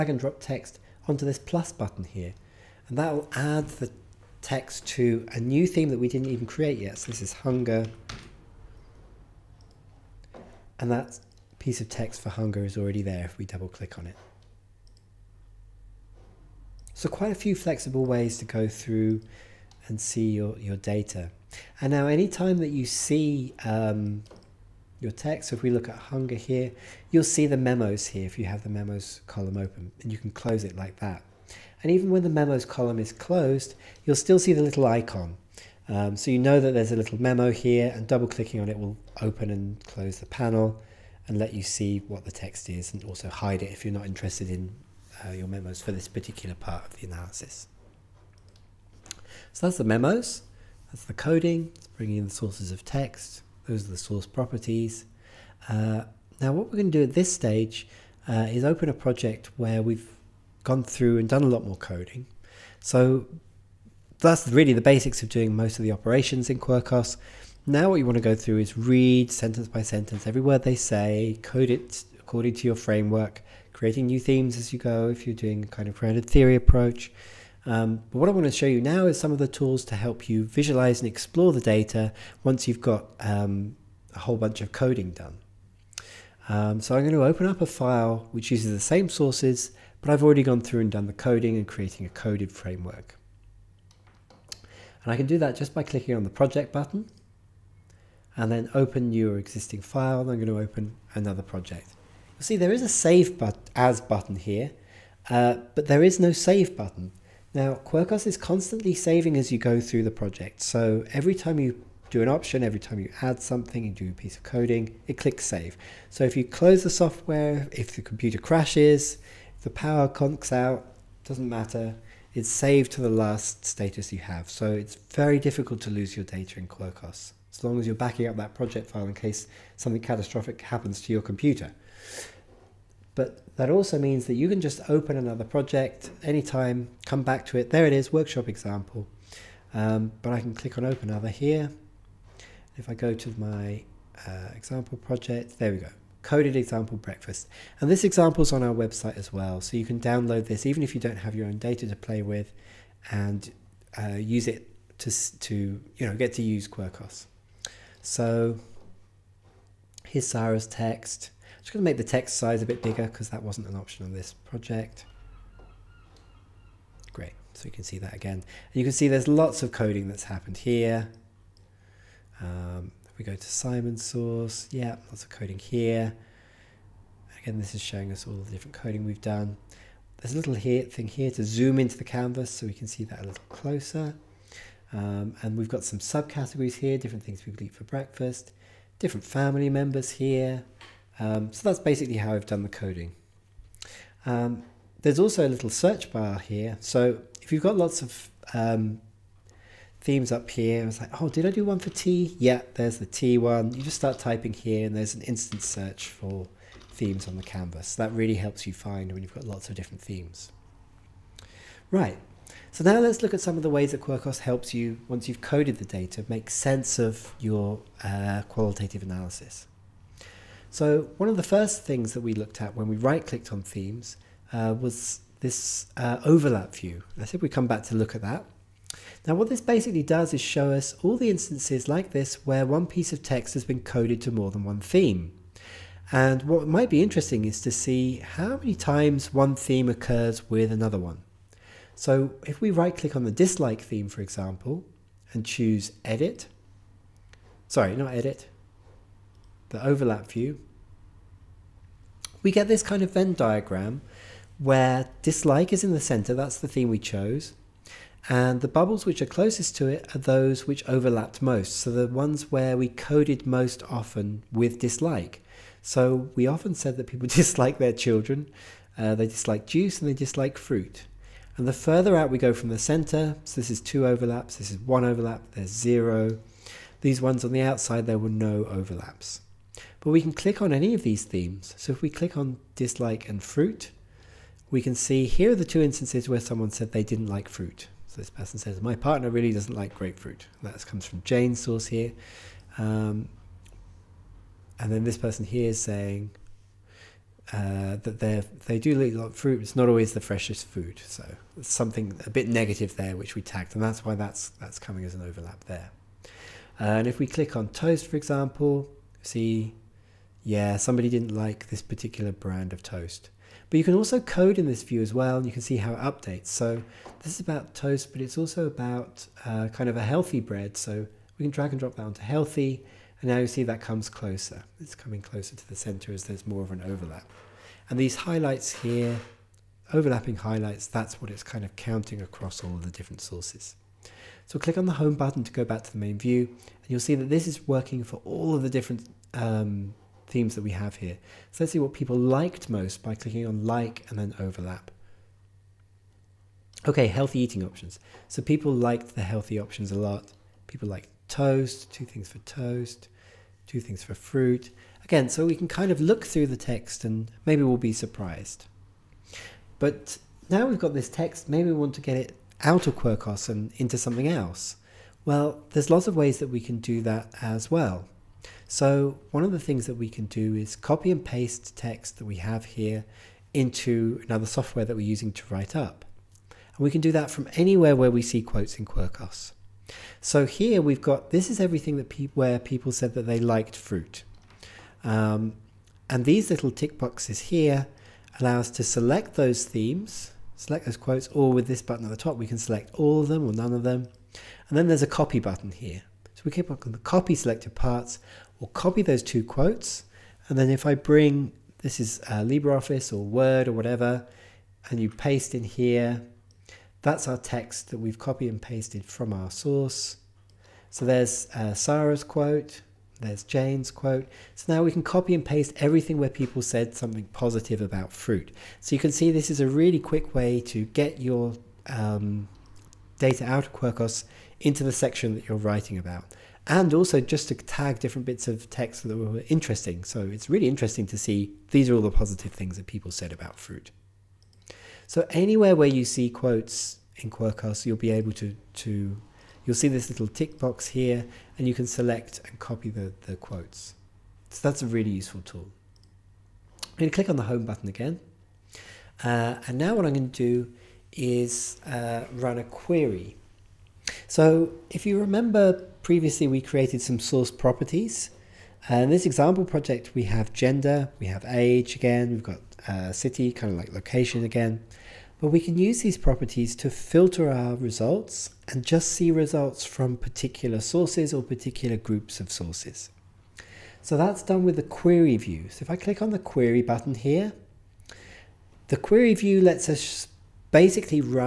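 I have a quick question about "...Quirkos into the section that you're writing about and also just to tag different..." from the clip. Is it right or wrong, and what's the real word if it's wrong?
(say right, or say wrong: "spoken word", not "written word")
right.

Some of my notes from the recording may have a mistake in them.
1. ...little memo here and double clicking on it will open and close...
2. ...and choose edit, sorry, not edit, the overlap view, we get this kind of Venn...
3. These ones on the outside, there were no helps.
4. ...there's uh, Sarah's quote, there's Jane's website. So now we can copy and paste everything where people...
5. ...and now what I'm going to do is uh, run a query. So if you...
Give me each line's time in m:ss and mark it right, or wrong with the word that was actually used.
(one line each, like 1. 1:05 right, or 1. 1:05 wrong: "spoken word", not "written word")
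1. 0:36 right
2. 4:05 right
3. 4:37 wrong: "overlaps", not "helps"
4. 6:51 wrong: "quote", not "website"
5. 7:29 right.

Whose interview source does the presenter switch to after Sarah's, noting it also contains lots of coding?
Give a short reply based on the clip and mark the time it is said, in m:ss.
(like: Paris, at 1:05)
Simon, at 2:53.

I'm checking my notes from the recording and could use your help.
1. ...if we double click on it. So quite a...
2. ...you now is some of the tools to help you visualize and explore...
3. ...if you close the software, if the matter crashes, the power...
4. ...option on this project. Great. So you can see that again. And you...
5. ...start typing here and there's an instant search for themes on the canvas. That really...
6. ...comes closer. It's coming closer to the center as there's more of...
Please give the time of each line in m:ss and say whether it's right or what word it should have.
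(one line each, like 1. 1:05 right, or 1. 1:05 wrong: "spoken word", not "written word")
1. 0:13 right
2. 1:18 right
3. 1:56 wrong: "computer", not "matter"
4. 2:43 right
5. 3:23 right
6. 5:23 right.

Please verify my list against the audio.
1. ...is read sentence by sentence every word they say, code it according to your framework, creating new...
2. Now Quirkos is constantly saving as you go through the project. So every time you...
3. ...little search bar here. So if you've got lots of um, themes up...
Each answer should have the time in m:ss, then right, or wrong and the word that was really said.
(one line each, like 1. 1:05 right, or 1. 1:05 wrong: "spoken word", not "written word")
1. 1:08 right
2. 1:47 right
3. 3:15 right.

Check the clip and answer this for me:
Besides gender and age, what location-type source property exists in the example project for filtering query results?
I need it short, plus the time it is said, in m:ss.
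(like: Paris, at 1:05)
City, at 7:43.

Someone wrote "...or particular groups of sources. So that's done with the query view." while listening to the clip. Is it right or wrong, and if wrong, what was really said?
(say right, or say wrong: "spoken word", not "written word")
right.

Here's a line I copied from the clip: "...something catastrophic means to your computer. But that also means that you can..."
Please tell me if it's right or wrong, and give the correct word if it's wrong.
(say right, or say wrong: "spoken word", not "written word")
wrong: "happens", not "means".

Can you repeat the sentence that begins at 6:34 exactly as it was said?
And then there's a copy button here.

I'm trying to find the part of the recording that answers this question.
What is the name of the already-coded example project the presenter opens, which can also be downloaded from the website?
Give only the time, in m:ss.
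2:26.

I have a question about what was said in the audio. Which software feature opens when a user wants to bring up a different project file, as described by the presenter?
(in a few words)
Project button.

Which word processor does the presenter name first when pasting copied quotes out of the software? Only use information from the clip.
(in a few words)
LibreOffice.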